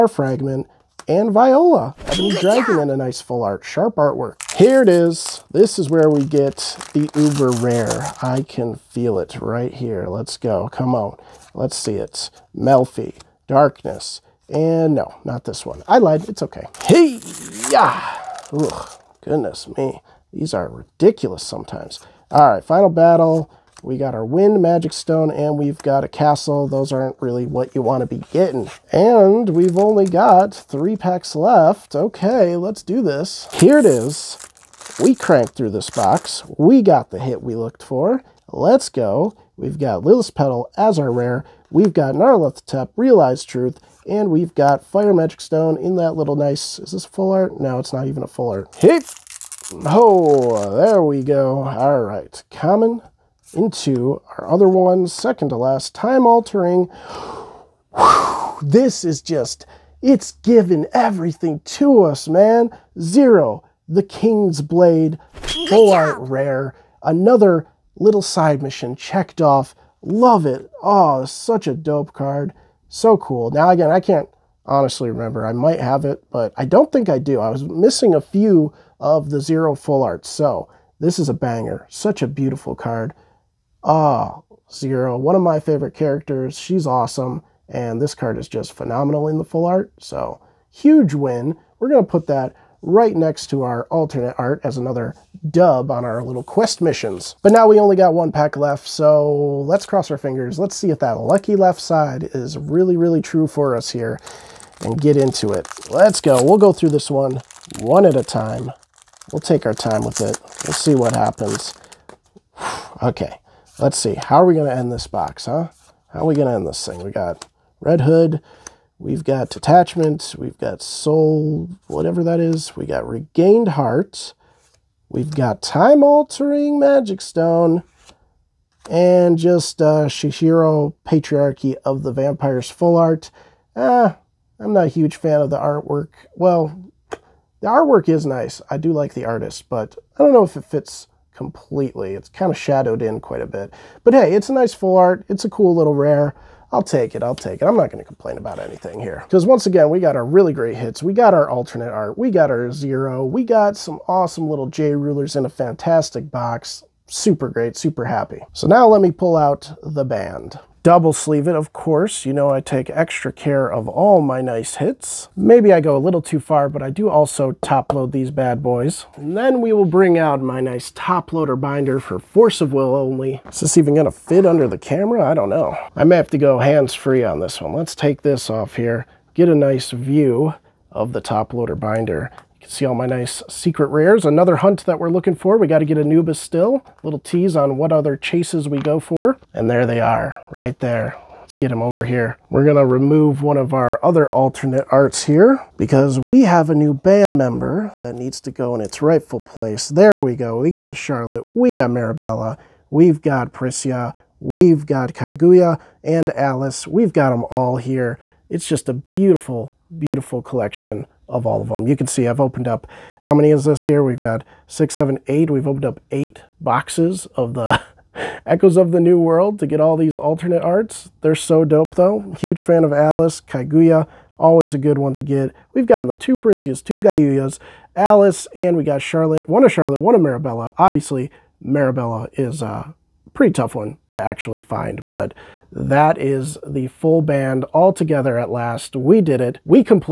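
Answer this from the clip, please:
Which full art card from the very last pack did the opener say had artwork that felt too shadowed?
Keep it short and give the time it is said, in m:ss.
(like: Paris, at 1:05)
Patriarchy of the Vampires, at 2:10.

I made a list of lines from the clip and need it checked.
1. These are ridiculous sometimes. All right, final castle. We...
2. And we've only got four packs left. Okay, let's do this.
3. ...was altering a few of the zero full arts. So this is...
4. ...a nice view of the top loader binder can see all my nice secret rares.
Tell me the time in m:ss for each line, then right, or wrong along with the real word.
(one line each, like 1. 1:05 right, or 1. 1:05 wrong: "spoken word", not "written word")
1. 0:20 wrong: "battle", not "castle"
2. 0:28 wrong: "three", not "four"
3. 1:17 wrong: "missing", not "altering"
4. 2:59 right.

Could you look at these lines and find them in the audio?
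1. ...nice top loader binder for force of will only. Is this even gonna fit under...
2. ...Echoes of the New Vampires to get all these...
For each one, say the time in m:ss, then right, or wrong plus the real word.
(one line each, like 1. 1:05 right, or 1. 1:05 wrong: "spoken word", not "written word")
1. 2:50 right
2. 3:38 wrong: "World", not "Vampires".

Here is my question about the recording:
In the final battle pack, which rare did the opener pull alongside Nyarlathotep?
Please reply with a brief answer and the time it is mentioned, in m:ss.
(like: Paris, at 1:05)
Lilith Petal, at 0:40.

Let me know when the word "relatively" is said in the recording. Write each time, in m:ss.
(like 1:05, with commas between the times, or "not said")
not said.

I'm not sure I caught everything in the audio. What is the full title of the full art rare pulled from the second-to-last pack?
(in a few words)
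Zero, the King's Blade.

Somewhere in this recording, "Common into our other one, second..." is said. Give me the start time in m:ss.
0:52.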